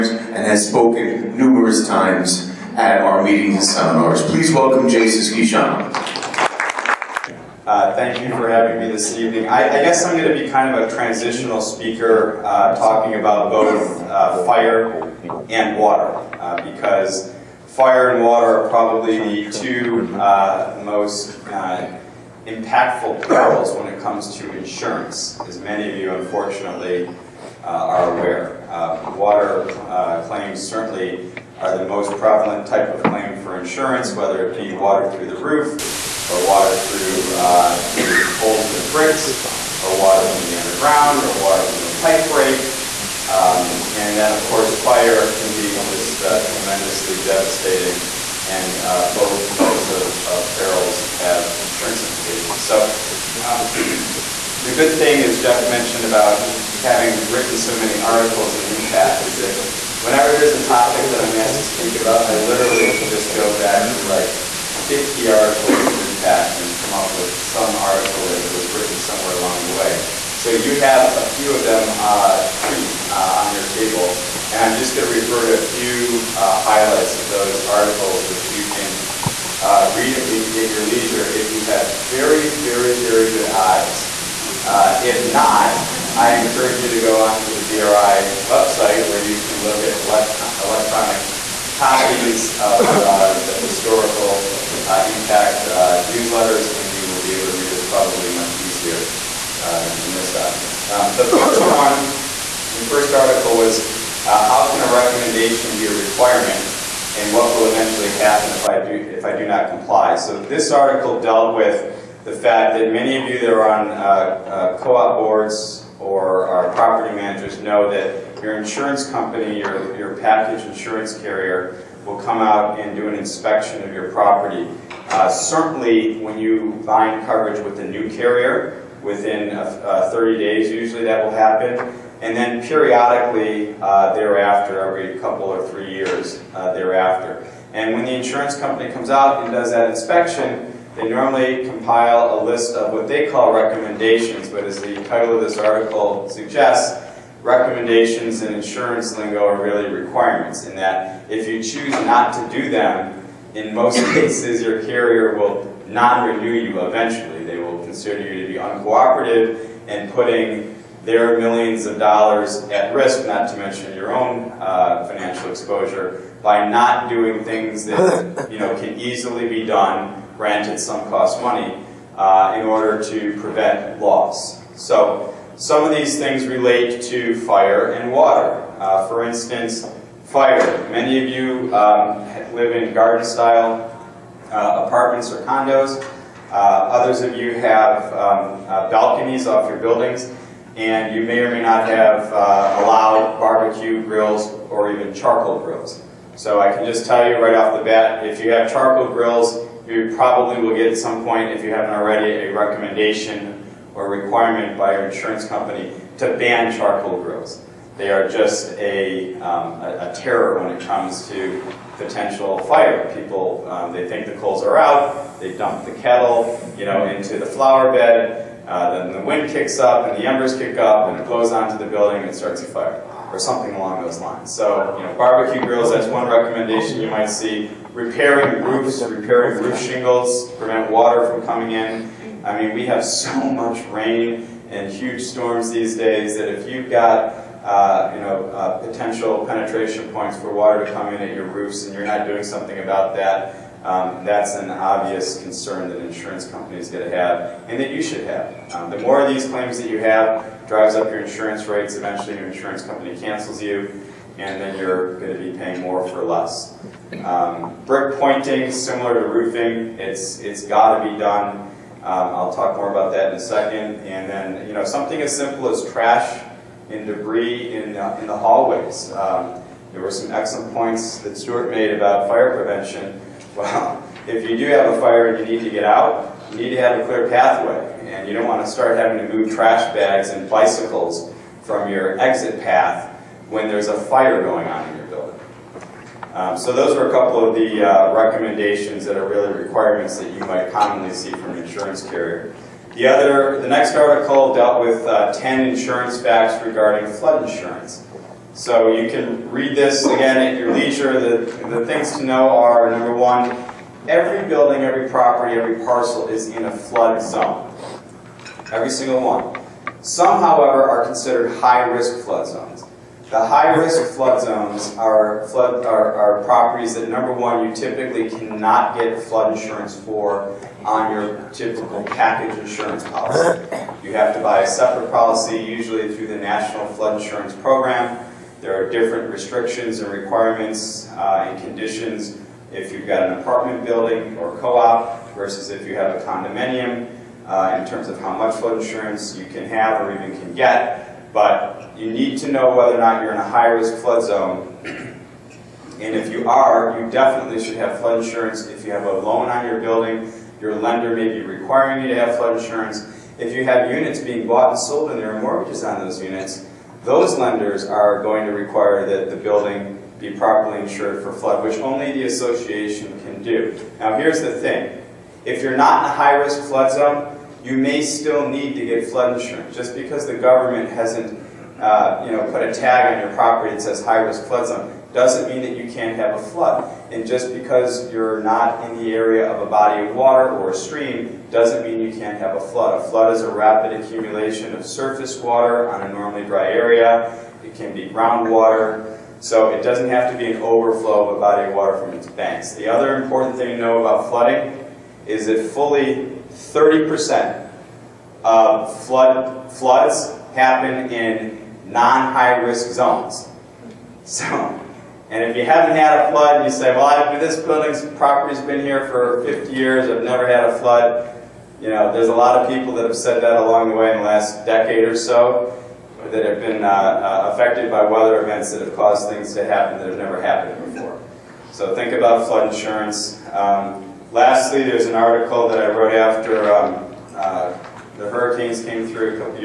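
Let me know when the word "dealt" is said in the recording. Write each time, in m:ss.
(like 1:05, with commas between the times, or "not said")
1:51, 4:54.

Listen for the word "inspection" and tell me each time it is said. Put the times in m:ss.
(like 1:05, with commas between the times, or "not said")
2:03, 2:19.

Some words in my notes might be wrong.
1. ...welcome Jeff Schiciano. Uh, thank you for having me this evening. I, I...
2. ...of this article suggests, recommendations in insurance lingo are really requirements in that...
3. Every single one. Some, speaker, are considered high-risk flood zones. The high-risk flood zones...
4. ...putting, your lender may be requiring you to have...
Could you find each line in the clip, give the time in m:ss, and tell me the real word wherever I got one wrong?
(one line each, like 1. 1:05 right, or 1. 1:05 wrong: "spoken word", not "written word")
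1. 0:04 wrong: "Jason", not "Jeff"
2. 2:25 right
3. 5:08 wrong: "however", not "speaker"
4. 5:49 wrong: "building", not "putting".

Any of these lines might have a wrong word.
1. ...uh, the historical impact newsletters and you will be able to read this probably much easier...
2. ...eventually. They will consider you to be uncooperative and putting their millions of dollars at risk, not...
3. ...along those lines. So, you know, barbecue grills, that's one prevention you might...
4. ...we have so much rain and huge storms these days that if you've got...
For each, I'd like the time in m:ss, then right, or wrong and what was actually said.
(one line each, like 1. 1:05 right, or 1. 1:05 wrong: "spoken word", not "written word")
1. 1:32 right
2. 2:36 right
3. 3:43 wrong: "recommendation", not "prevention"
4. 3:52 right.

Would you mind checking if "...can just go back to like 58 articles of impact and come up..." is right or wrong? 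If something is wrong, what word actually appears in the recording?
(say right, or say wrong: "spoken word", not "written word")
wrong: "50", not "58".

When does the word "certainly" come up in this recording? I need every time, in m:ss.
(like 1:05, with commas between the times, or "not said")
0:30, 2:05.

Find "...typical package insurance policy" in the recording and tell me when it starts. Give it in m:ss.
5:21.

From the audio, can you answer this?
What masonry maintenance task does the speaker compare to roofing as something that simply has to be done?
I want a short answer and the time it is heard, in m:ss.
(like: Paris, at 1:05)
Brick pointing, at 4:17.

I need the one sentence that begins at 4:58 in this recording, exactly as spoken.
So you can read this again at your leisure.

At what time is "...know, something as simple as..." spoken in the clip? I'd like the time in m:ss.
4:24.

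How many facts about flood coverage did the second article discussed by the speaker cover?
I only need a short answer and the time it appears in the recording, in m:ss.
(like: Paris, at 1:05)
10, at 4:55.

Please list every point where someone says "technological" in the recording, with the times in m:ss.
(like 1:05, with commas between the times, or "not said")
not said.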